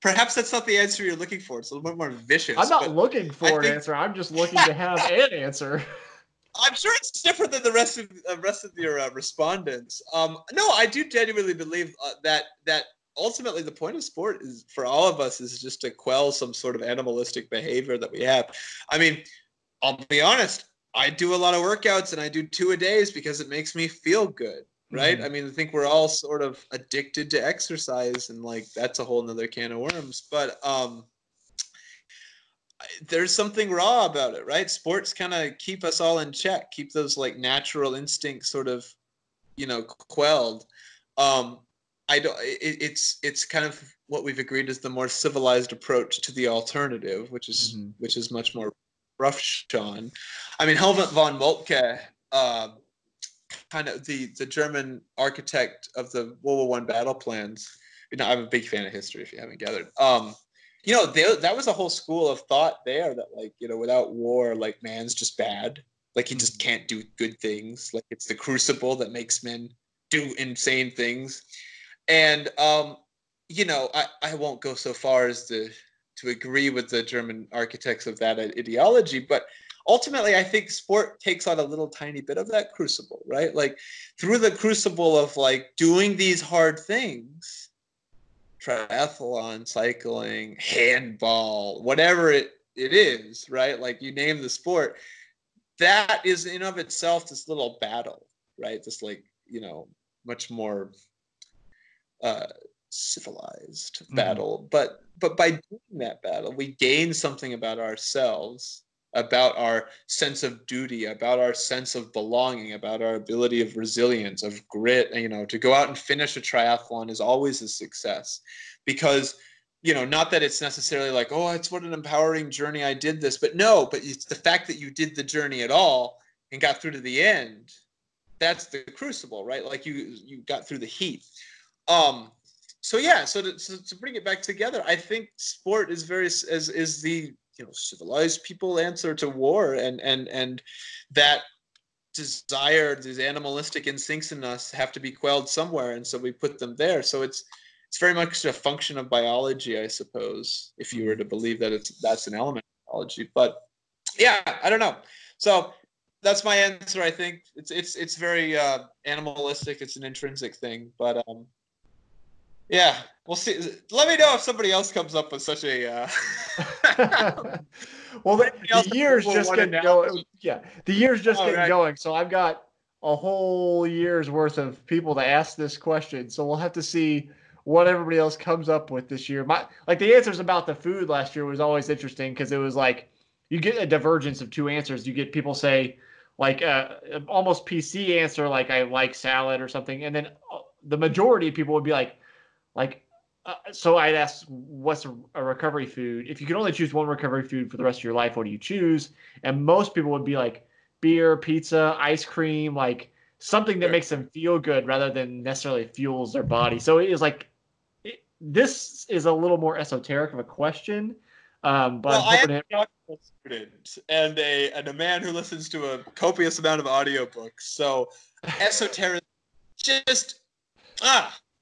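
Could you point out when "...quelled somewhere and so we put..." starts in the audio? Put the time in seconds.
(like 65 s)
145 s.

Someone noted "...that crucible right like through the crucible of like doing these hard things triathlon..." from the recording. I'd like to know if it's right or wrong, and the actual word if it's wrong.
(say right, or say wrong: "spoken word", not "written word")
right.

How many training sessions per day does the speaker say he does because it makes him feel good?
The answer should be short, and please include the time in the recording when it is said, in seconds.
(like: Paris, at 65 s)
2, at 22 s.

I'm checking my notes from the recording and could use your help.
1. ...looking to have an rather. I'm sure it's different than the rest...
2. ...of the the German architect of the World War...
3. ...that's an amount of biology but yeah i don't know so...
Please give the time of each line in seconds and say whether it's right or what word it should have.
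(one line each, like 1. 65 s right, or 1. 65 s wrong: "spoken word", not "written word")
1. 4 s wrong: "answer", not "rather"
2. 53 s right
3. 152 s wrong: "element", not "amount".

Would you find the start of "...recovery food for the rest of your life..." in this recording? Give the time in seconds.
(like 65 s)
197 s.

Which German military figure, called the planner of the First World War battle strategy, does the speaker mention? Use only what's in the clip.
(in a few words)
Helmut von Moltke.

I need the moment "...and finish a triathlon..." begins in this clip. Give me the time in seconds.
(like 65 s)
115 s.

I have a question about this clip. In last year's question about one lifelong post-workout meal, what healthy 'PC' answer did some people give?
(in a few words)
salad.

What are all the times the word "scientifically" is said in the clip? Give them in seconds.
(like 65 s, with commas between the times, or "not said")
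not said.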